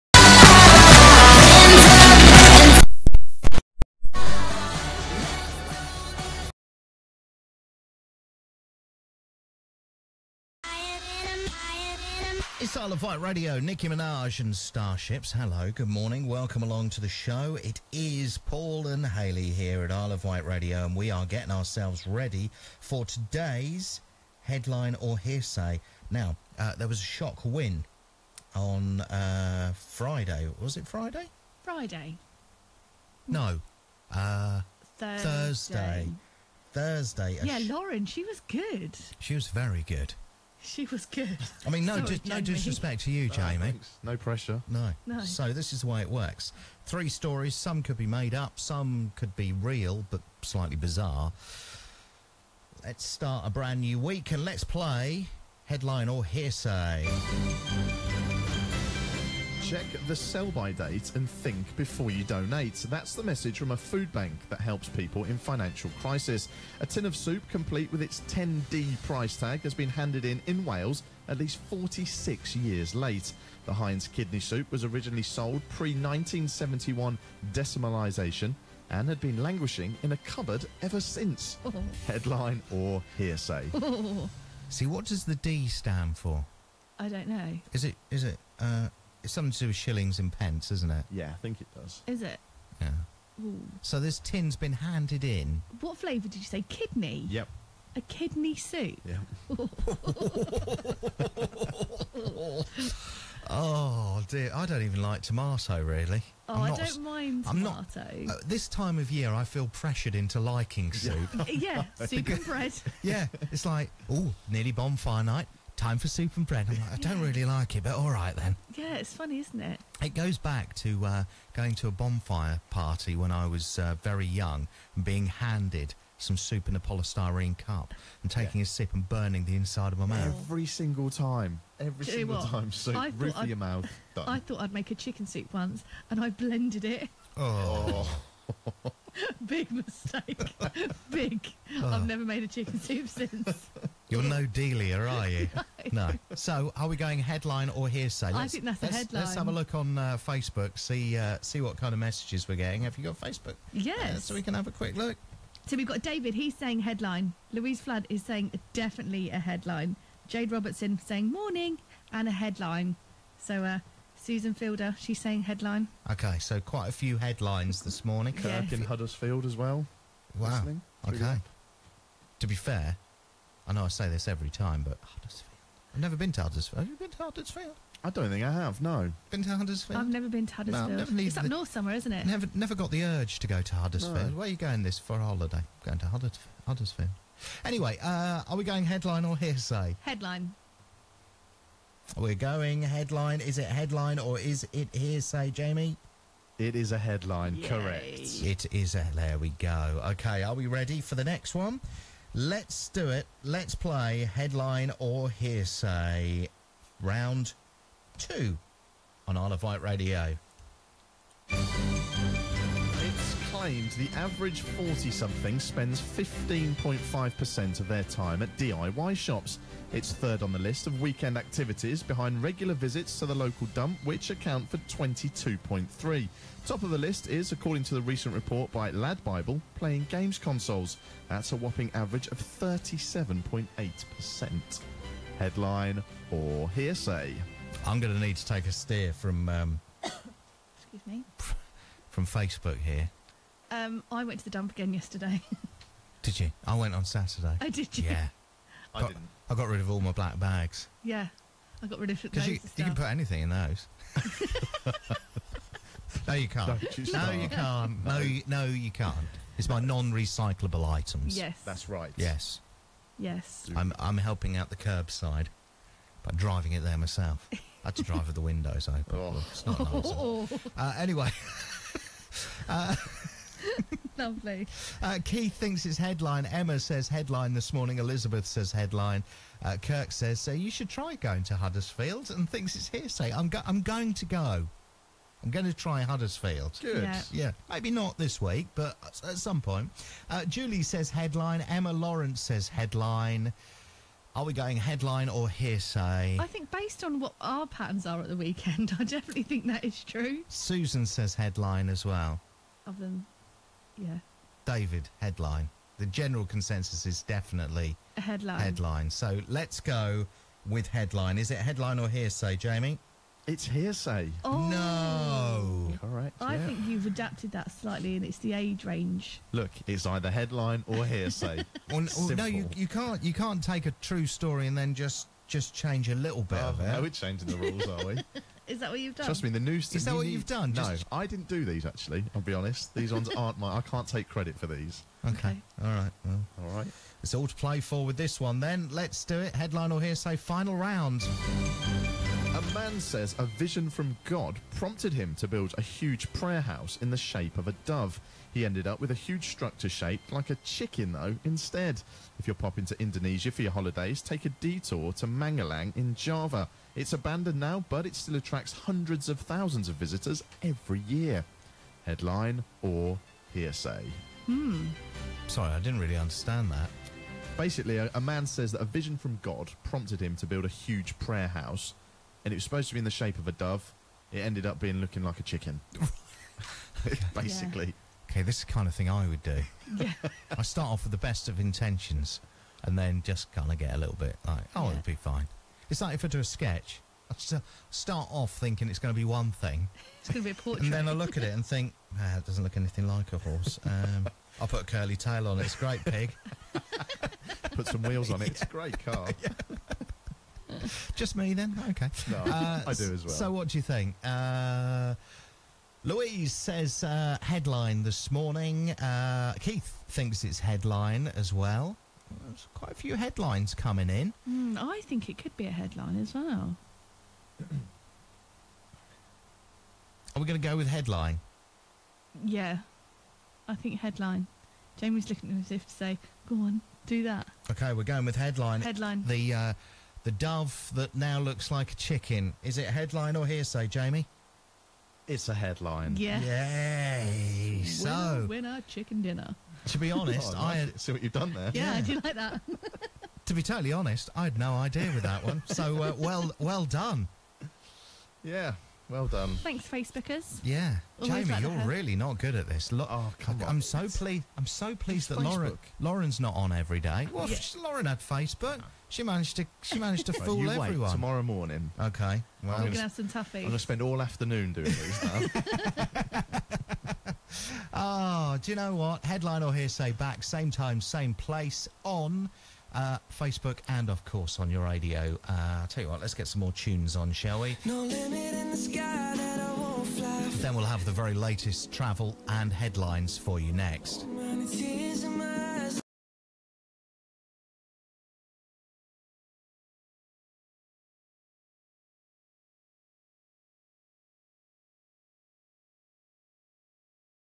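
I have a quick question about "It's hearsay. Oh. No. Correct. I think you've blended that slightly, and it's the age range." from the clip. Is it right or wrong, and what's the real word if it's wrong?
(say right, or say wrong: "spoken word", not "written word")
wrong: "adapted", not "blended".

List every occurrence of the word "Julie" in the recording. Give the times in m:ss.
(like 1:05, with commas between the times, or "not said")
4:50.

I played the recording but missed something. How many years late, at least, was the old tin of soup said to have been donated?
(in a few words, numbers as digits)
46.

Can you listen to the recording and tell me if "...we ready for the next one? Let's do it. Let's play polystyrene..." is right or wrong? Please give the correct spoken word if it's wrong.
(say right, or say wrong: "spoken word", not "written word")
wrong: "headline", not "polystyrene".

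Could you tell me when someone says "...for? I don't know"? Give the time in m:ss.
1:26.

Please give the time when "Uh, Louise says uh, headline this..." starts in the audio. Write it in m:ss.
6:44.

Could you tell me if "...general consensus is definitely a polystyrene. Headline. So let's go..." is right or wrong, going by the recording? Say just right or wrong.
wrong.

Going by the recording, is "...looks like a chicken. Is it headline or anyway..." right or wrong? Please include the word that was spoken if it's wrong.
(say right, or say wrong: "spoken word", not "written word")
wrong: "hearsay", not "anyway".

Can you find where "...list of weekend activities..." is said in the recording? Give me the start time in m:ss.
3:40.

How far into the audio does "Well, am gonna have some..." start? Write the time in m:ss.
7:42.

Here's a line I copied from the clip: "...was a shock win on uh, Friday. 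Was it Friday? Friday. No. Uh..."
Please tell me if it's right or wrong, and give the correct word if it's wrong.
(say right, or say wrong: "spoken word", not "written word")
right.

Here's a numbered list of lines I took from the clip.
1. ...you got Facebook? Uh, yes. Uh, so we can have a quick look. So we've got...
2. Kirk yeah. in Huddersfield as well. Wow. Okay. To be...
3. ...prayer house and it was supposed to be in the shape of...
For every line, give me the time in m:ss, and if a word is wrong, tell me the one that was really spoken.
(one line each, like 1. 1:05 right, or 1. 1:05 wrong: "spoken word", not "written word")
1. 2:32 right
2. 2:48 right
3. 6:11 right.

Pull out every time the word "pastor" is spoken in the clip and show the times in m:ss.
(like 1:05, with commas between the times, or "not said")
not said.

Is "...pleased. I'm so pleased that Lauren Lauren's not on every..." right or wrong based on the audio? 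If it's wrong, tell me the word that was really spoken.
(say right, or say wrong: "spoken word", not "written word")
right.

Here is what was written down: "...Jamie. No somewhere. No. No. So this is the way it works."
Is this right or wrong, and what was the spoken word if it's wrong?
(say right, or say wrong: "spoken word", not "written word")
wrong: "pressure", not "somewhere".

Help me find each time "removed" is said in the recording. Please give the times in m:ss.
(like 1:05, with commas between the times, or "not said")
not said.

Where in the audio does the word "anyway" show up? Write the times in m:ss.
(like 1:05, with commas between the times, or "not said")
3:07, 4:30.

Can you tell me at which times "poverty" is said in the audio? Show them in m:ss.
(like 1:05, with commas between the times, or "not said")
not said.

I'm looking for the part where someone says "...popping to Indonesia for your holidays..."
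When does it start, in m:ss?
5:52.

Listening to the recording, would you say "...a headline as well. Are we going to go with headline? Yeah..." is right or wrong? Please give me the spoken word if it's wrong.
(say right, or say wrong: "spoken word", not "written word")
right.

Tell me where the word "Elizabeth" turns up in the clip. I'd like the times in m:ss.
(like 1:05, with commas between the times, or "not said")
4:37.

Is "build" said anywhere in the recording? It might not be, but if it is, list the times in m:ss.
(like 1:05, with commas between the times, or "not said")
5:45, 6:10.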